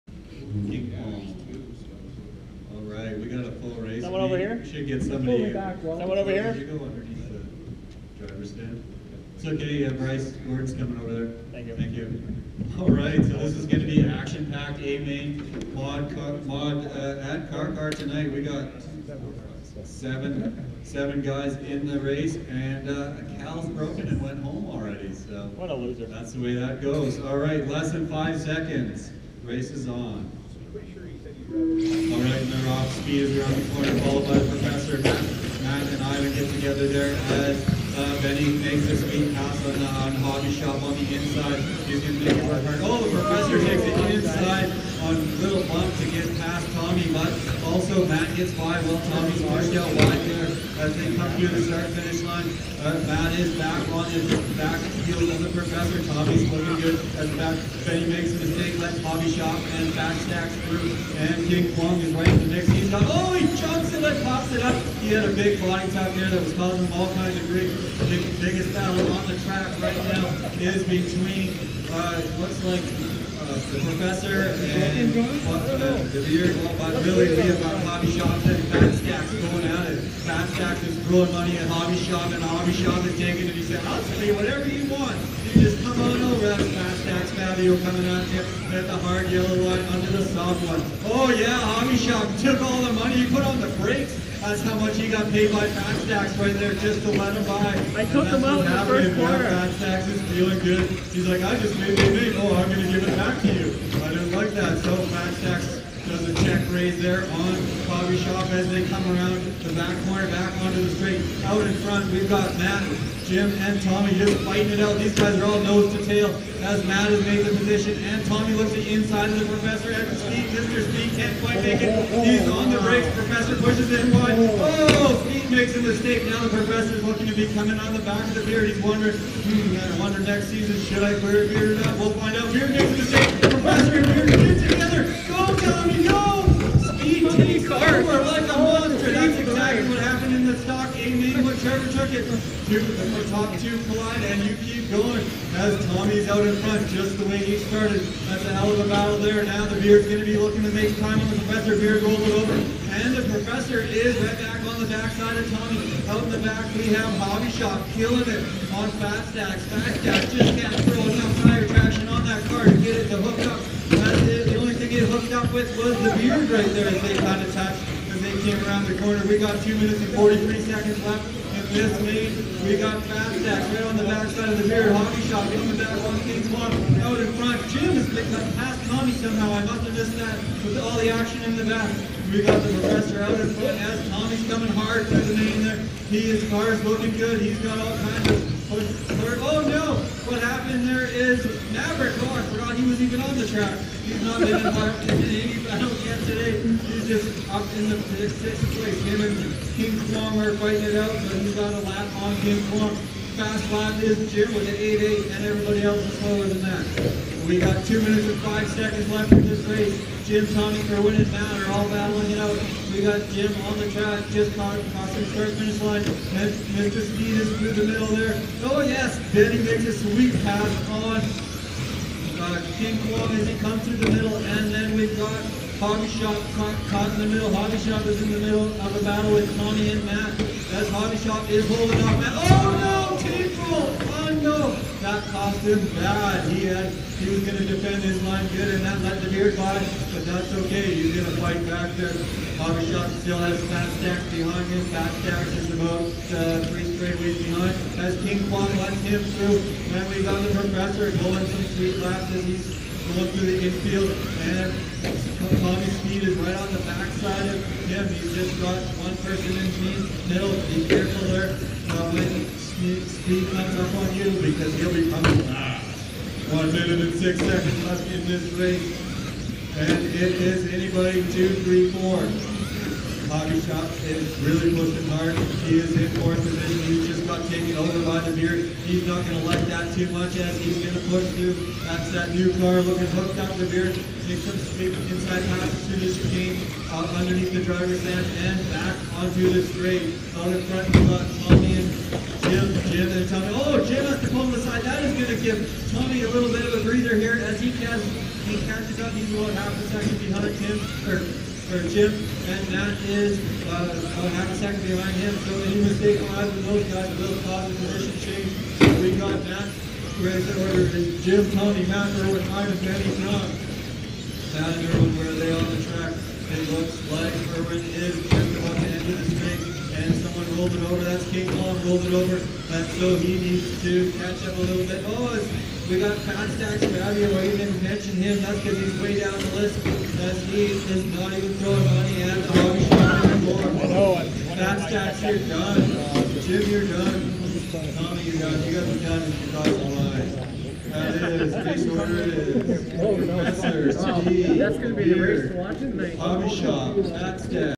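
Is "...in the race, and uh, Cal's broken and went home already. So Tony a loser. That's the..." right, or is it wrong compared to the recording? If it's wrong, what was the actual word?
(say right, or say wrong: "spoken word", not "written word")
wrong: "What", not "Tony".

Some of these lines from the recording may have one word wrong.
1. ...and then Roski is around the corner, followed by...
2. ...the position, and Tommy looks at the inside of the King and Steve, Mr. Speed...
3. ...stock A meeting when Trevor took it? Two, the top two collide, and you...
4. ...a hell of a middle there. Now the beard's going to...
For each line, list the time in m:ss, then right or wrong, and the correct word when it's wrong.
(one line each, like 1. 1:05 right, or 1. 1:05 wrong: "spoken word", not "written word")
1. 0:32 right
2. 1:57 wrong: "Professor", not "King"
3. 2:20 right
4. 2:28 wrong: "battle", not "middle".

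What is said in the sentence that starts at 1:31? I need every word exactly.
Oh yeah, hobby shop took all the money.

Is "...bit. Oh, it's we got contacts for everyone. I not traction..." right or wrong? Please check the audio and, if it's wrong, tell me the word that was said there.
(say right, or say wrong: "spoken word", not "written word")
wrong: "mention", not "traction".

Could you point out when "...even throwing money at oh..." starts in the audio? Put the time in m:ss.
5:31.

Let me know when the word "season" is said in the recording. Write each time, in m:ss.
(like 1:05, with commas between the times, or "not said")
2:10.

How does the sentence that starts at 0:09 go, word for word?
It's okay, have Bryce, Gordon's coming over there.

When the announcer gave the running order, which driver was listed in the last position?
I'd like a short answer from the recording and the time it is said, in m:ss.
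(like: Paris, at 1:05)
Tom, at 5:13.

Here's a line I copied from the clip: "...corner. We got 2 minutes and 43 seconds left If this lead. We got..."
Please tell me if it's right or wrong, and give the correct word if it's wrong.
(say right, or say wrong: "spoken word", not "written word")
right.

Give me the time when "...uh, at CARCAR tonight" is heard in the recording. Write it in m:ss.
0:16.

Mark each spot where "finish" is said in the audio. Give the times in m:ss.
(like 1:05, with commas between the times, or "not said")
0:51, 3:35.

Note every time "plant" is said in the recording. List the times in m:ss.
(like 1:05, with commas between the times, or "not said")
not said.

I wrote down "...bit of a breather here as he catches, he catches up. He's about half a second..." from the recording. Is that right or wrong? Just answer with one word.
right.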